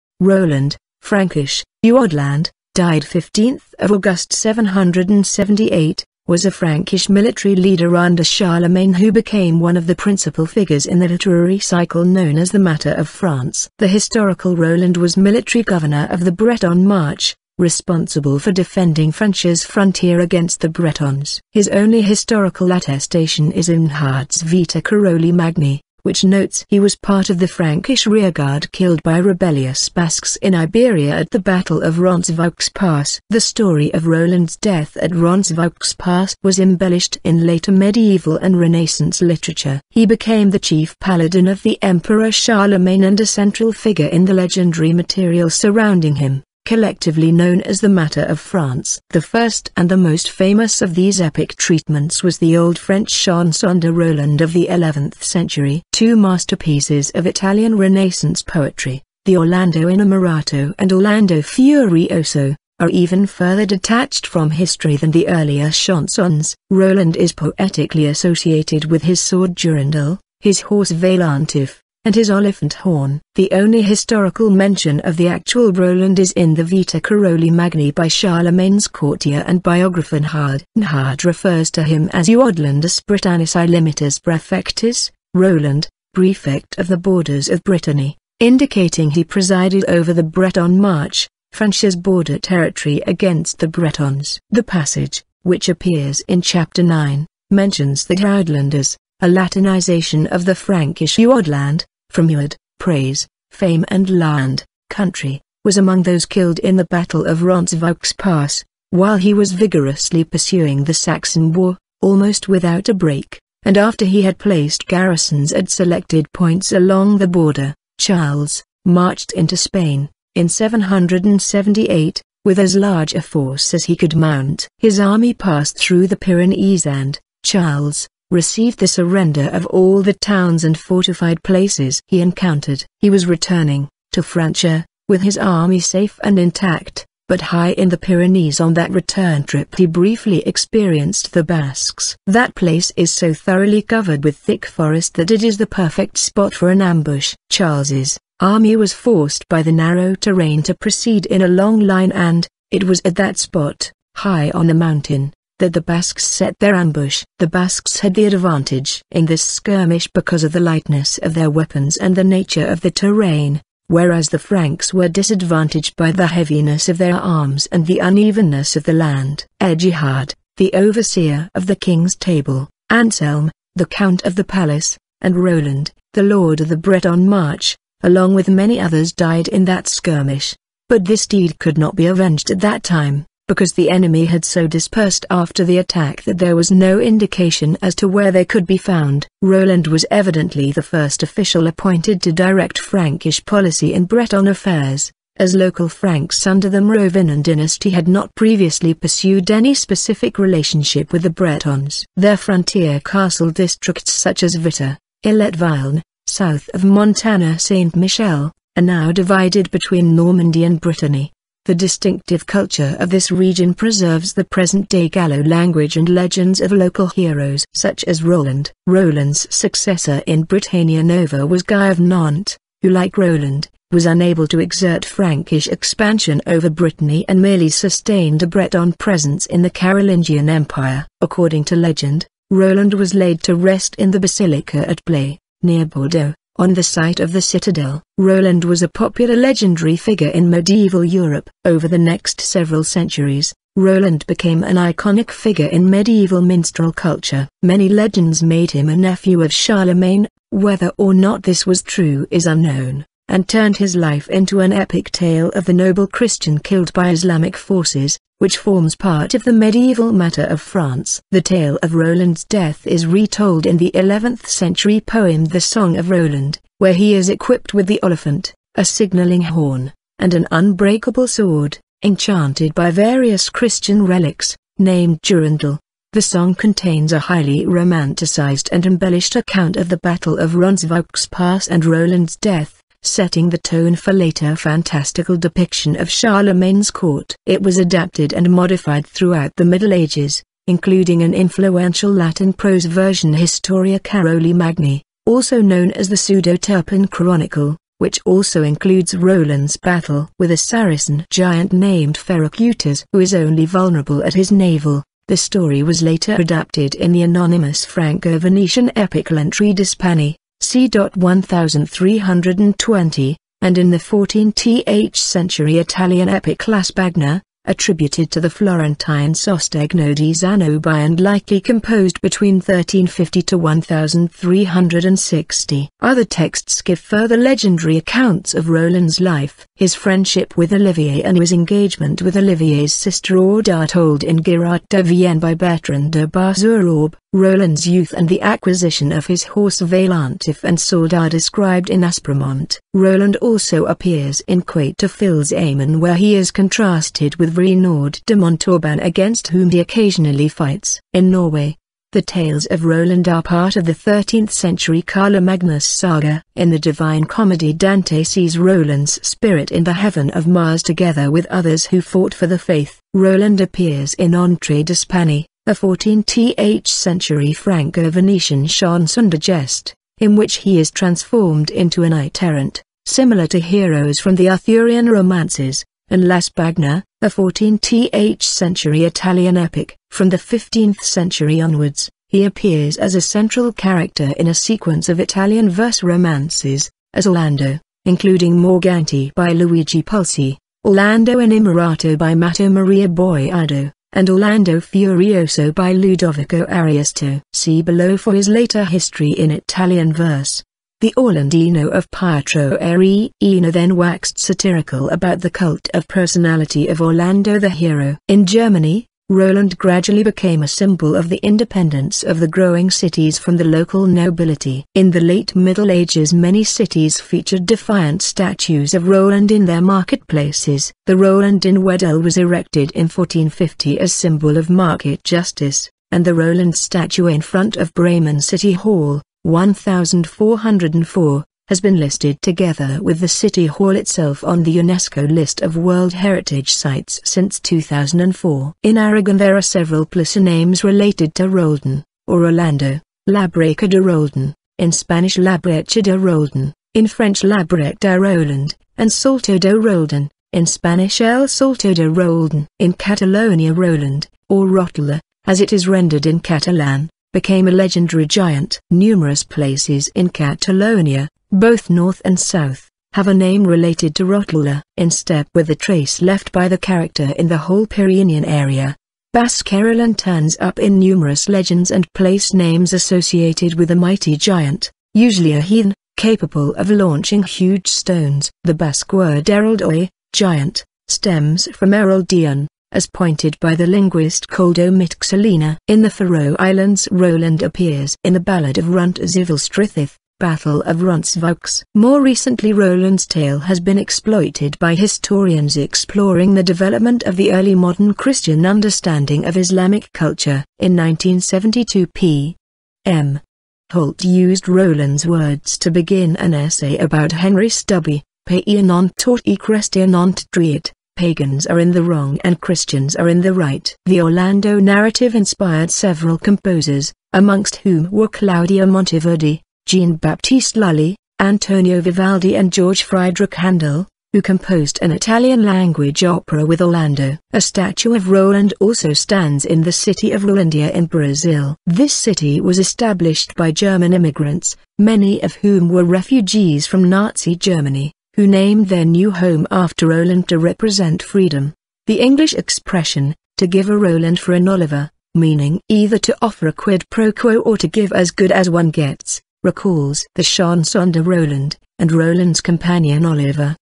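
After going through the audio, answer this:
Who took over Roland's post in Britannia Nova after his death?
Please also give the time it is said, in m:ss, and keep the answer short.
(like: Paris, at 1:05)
Guy of Nantes, at 3:41.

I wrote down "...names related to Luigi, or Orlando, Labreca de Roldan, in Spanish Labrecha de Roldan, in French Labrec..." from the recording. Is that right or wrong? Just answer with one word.
wrong.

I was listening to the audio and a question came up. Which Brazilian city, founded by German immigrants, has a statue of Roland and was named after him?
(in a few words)
Rolandia.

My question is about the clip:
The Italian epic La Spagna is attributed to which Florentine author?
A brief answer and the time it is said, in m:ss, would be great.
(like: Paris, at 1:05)
Sostegno di Zanobi, at 5:19.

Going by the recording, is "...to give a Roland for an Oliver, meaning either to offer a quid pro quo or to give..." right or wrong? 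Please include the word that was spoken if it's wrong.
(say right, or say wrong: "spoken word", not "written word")
right.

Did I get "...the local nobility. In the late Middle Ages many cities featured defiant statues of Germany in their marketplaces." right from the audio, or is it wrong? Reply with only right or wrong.
wrong.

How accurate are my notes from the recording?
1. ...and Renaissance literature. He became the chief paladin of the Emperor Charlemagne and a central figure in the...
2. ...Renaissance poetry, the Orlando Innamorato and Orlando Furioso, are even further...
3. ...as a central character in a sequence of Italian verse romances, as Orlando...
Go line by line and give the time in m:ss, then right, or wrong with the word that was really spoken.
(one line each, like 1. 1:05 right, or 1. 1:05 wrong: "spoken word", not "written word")
1. 0:38 right
2. 0:57 right
3. 6:22 right.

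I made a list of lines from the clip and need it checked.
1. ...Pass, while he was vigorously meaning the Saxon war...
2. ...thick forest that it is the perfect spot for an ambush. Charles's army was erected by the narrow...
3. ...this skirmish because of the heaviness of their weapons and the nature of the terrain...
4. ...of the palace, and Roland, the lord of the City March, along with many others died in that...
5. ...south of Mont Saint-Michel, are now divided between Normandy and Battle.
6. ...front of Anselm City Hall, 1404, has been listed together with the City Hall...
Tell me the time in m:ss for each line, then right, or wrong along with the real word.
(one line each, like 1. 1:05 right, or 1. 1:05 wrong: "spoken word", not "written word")
1. 1:48 wrong: "pursuing", not "meaning"
2. 2:24 wrong: "forced", not "erected"
3. 2:39 wrong: "lightness", not "heaviness"
4. 2:54 wrong: "Breton", not "City"
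5. 3:26 wrong: "Brittany", not "Battle"
6. 7:07 wrong: "Bremen", not "Anselm".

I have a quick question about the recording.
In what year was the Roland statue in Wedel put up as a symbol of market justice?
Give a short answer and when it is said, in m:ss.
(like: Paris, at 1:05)
1450, at 7:03.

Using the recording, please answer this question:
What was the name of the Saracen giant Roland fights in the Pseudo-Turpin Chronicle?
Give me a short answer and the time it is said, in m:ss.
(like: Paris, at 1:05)
Ferracutus, at 5:02.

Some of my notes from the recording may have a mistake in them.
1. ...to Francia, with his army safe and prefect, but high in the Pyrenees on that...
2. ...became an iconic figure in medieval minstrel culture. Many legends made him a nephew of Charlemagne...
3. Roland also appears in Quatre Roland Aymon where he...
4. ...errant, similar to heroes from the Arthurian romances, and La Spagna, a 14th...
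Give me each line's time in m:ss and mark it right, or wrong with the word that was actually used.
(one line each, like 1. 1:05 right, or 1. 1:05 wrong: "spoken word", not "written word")
1. 2:14 wrong: "intact", not "prefect"
2. 4:04 right
3. 5:42 wrong: "Fils", not "Roland"
4. 6:12 right.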